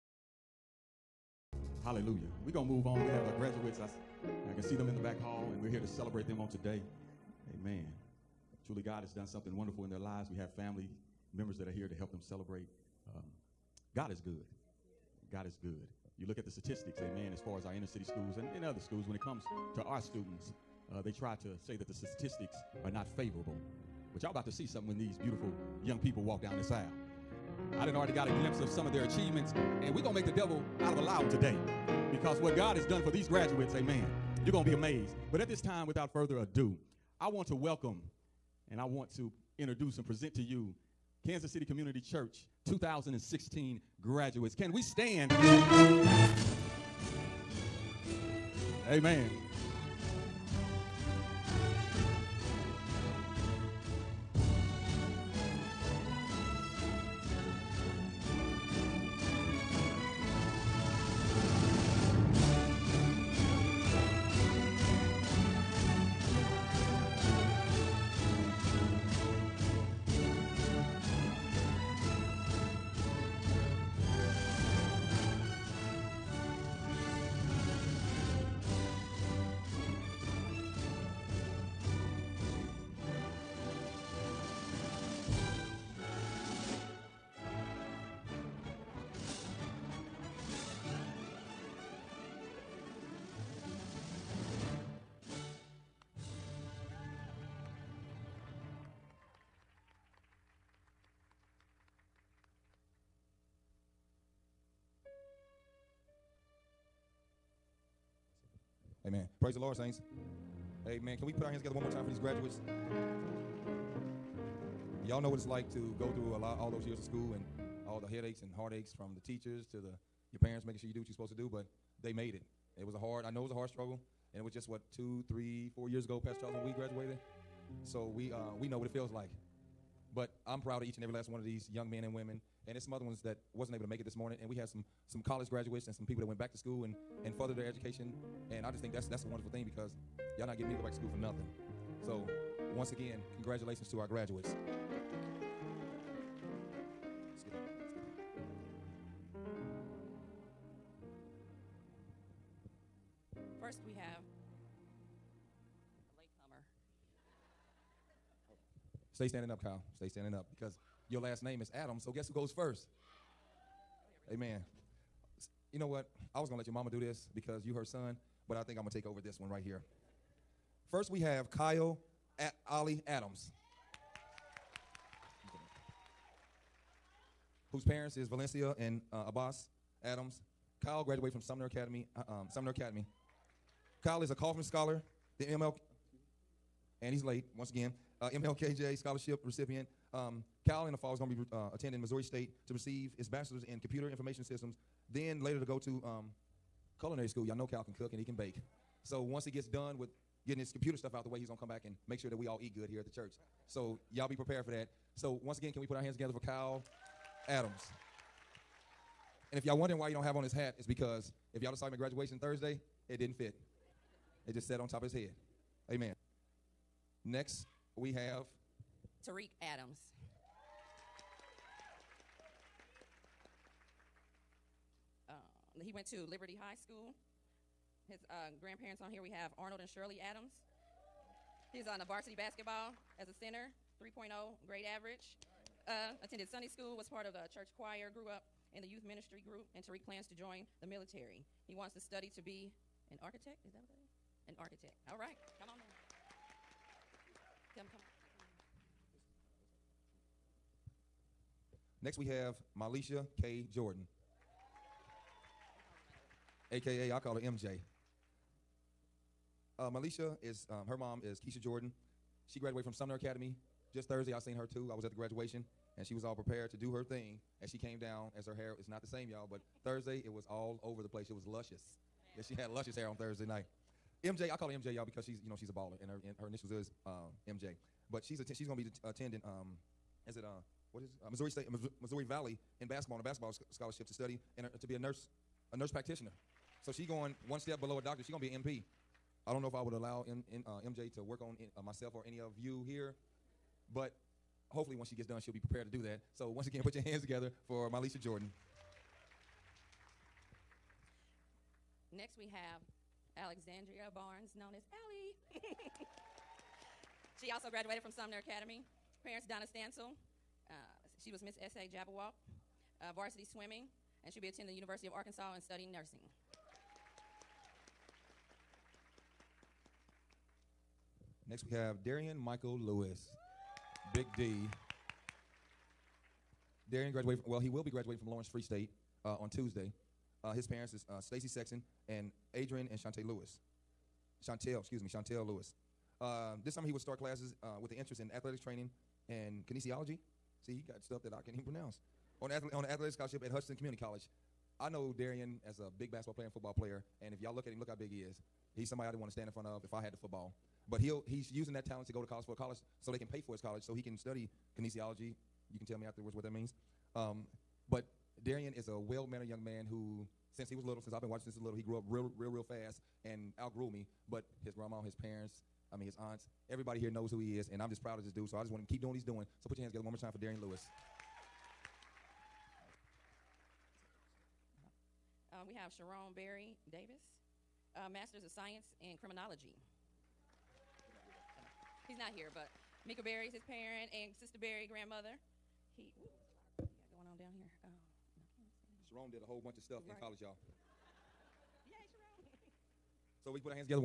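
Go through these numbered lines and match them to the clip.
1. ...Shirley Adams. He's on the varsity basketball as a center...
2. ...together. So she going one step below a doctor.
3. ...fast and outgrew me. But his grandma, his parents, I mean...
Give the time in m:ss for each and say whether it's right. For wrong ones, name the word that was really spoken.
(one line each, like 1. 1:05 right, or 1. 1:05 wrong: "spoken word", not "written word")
1. 3:49 right
2. 4:45 wrong: "practitioner", not "together"
3. 6:02 right.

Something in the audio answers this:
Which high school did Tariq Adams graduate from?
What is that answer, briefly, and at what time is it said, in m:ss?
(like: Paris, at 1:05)
Liberty High School, at 3:46.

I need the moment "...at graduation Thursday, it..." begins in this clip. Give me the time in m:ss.
3:31.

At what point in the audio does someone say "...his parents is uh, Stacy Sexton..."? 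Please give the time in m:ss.
5:30.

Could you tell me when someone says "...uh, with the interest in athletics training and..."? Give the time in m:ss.
5:37.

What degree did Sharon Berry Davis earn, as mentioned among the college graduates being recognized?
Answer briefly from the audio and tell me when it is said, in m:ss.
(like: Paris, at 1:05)
Masters of Science in Criminology, at 6:18.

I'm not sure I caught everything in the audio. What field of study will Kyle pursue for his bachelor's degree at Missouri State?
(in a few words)
computer information systems.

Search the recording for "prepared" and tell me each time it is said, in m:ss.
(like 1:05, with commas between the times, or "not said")
3:24, 4:26, 4:55.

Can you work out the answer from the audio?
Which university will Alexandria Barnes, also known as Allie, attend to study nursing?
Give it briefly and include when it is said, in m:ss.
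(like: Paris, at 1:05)
University of Arkansas, at 5:14.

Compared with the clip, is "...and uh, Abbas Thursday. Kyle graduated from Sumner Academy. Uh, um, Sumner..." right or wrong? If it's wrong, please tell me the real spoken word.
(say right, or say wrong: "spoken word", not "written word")
wrong: "Adams", not "Thursday".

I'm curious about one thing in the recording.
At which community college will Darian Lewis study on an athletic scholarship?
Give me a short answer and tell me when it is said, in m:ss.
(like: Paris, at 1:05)
Hutchinson Community College, at 5:43.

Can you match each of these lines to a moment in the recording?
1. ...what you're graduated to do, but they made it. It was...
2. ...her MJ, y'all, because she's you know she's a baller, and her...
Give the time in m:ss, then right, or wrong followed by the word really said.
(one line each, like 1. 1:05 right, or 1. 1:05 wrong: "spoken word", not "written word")
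1. 2:00 wrong: "supposed", not "graduated"
2. 4:34 right.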